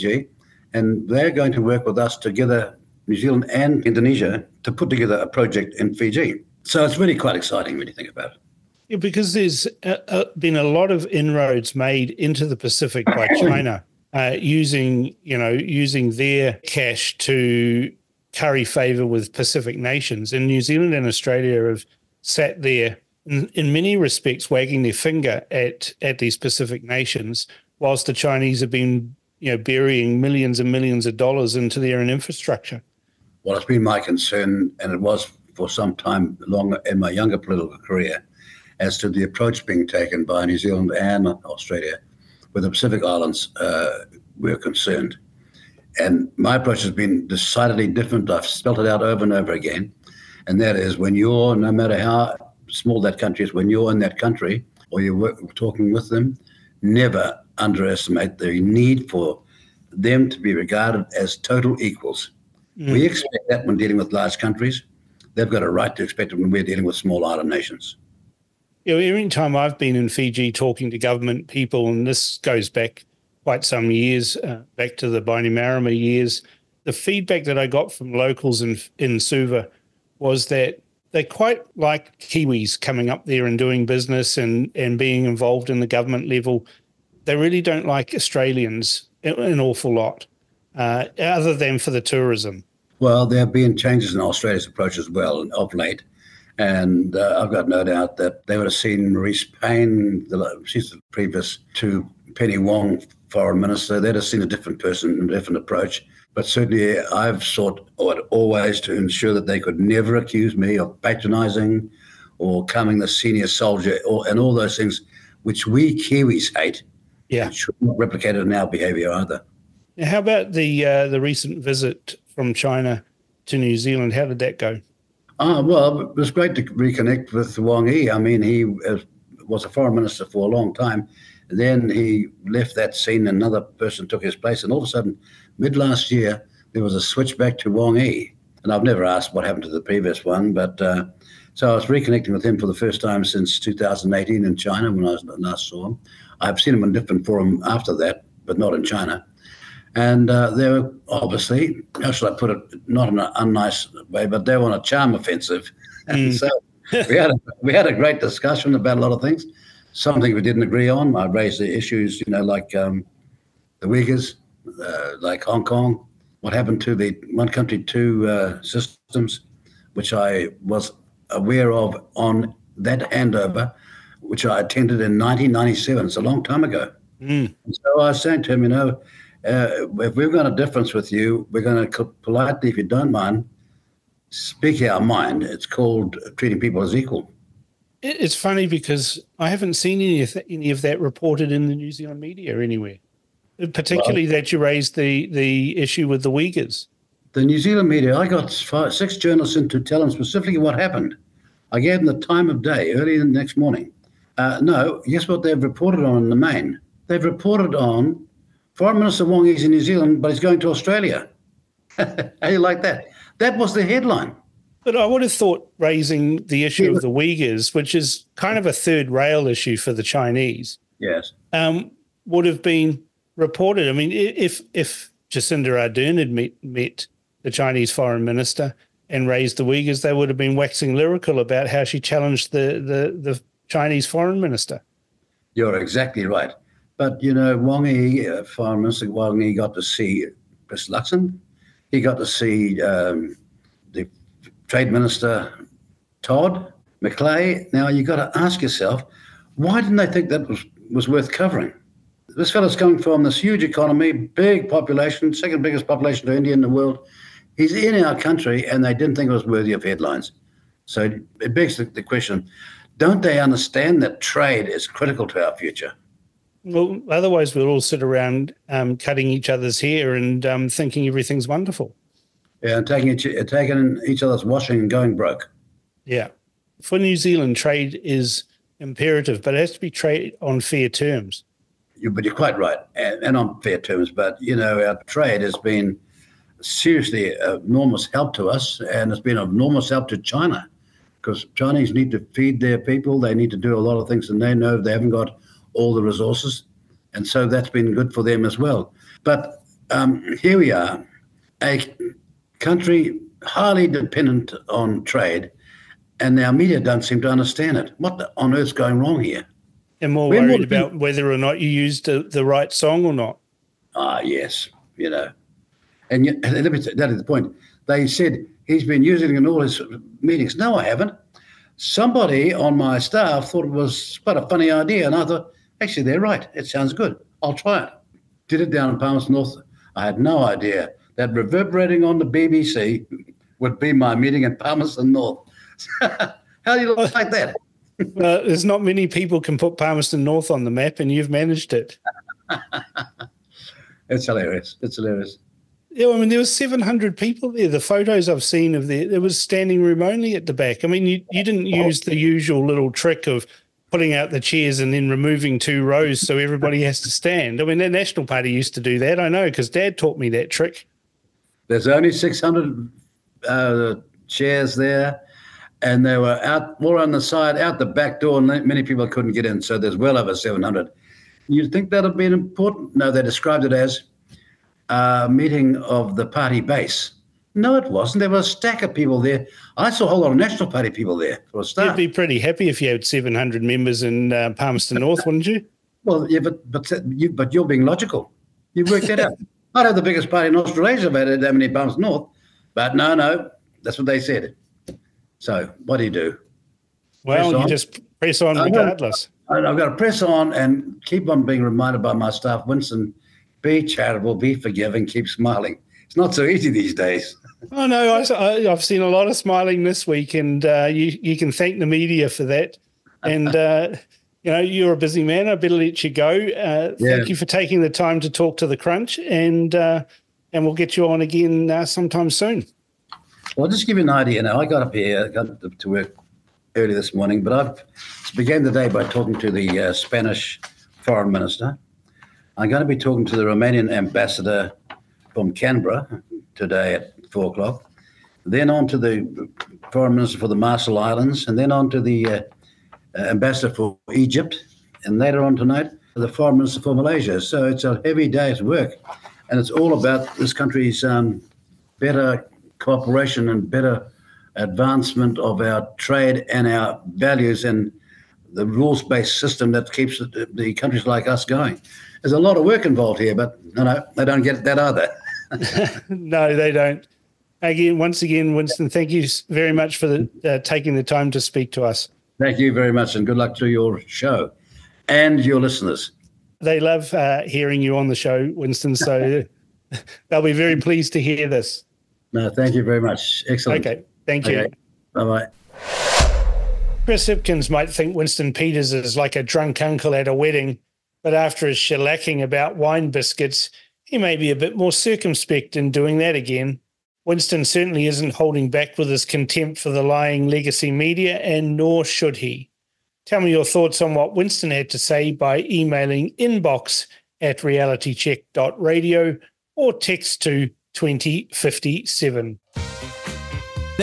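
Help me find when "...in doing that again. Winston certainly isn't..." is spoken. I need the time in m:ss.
8:15.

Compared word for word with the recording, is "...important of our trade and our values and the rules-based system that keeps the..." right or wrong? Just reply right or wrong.
wrong.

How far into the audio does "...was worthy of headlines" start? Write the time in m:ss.
4:19.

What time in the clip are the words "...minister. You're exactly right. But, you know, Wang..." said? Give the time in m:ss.
3:54.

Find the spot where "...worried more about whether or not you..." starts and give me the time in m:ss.
5:10.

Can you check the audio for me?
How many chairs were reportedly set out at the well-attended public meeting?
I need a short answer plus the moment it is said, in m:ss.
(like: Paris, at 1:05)
600, at 6:02.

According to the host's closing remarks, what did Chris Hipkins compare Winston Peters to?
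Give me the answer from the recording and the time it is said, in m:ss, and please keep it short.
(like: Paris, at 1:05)
a drunk uncle, at 8:09.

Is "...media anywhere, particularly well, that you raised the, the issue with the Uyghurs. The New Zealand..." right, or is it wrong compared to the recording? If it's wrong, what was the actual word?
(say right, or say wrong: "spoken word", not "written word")
right.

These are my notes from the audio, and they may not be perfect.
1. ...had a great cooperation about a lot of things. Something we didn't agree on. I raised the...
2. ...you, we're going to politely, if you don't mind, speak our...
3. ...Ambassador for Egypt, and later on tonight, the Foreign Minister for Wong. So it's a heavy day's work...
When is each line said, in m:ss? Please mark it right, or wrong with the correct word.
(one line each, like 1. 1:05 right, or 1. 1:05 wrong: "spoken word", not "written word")
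1. 2:37 wrong: "discussion", not "cooperation"
2. 3:01 right
3. 7:23 wrong: "Malaysia", not "Wong".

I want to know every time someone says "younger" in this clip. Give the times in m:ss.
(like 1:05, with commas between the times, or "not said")
0:37.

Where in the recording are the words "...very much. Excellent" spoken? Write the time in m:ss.
8:02.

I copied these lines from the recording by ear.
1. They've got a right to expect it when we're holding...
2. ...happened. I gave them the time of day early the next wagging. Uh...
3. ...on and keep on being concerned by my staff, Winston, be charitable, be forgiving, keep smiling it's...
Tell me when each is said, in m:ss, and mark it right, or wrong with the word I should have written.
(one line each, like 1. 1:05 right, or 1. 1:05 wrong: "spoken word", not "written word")
1. 1:05 wrong: "dealing", not "holding"
2. 3:20 wrong: "morning", not "wagging"
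3. 6:40 wrong: "reminded", not "concerned".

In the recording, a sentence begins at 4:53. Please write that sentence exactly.
They need to do a lot of things, and they know they haven't got all the resources.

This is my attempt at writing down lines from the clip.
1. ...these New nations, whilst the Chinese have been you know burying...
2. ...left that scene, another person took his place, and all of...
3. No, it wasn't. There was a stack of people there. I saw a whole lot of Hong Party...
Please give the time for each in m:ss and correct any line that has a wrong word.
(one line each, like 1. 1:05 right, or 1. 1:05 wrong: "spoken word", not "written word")
1. 0:26 wrong: "Pacific", not "New"
2. 2:12 right
3. 6:17 wrong: "National", not "Hong".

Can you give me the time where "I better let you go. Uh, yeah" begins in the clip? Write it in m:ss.
6:55.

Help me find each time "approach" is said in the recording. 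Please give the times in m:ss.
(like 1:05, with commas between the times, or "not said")
0:39, 0:46, 1:34, 1:45.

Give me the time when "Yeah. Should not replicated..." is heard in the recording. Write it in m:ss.
1:57.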